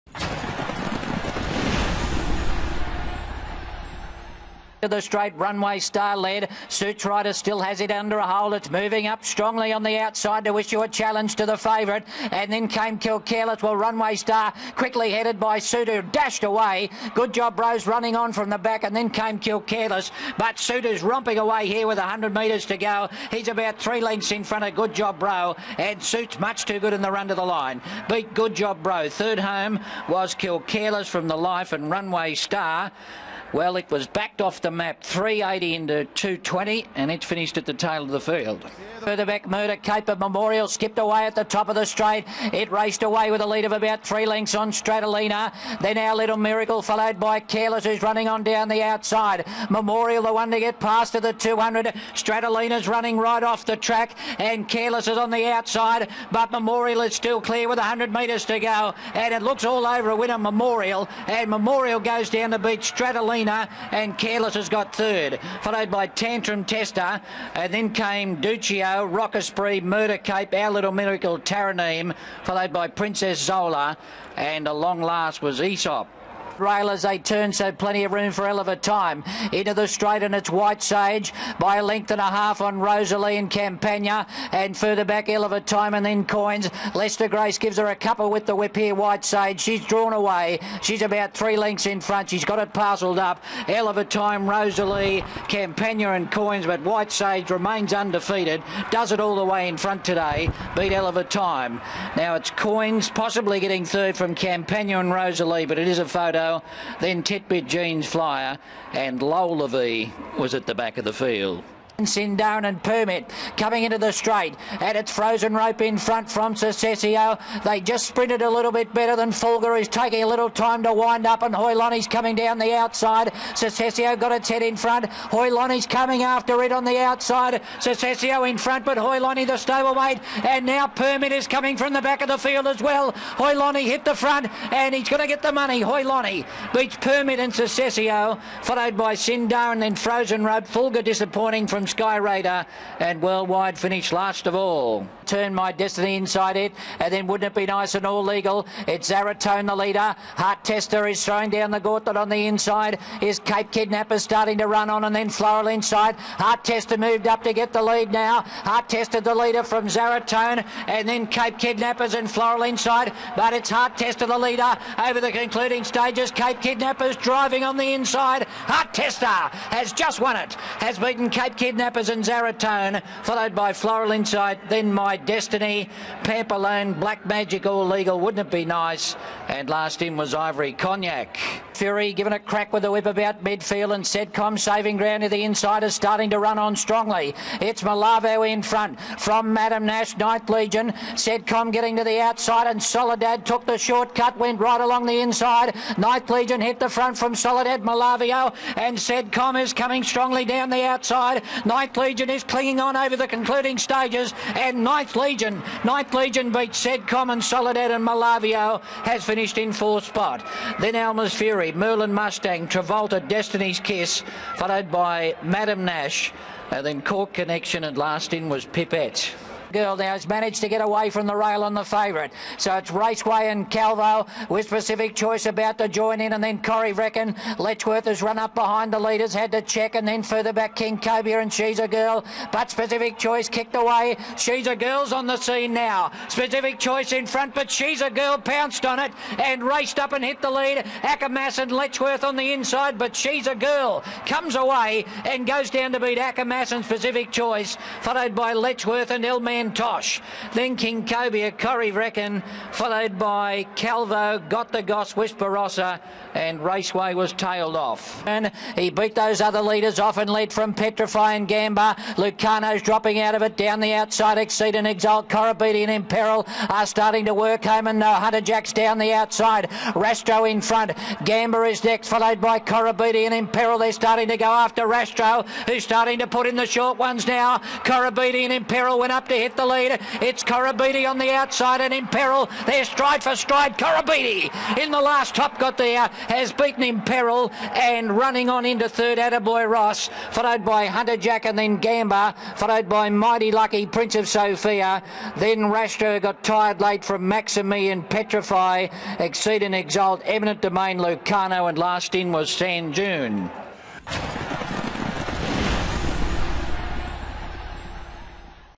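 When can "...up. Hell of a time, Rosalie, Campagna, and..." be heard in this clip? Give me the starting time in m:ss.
1:33.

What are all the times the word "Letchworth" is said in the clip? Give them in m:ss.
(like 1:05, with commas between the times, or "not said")
3:47, 4:01, 4:08.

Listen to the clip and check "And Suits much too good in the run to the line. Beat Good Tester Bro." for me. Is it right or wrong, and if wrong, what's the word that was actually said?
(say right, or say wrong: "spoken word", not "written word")
wrong: "Job", not "Tester".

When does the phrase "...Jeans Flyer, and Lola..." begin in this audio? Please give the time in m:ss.
1:47.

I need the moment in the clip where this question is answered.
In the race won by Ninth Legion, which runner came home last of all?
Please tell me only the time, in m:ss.
3:38.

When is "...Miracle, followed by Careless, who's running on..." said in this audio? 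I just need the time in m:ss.
0:46.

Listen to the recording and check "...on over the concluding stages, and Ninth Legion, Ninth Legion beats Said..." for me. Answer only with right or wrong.
right.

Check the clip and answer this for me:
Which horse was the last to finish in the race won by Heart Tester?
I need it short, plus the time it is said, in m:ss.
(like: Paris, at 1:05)
Ivory Cognac, at 3:00.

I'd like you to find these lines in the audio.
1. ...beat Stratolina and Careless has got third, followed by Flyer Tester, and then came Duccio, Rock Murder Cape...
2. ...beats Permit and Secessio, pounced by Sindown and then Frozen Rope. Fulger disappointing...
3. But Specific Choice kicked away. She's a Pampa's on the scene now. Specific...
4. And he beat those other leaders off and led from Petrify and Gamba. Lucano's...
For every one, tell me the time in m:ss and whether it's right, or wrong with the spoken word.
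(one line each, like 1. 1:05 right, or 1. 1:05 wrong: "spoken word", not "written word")
1. 1:02 wrong: "Tantrum", not "Flyer"
2. 2:16 wrong: "followed", not "pounced"
3. 3:52 wrong: "Girl", not "Pampa"
4. 4:18 right.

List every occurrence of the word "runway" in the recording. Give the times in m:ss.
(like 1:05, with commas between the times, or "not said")
0:05, 0:13, 0:31.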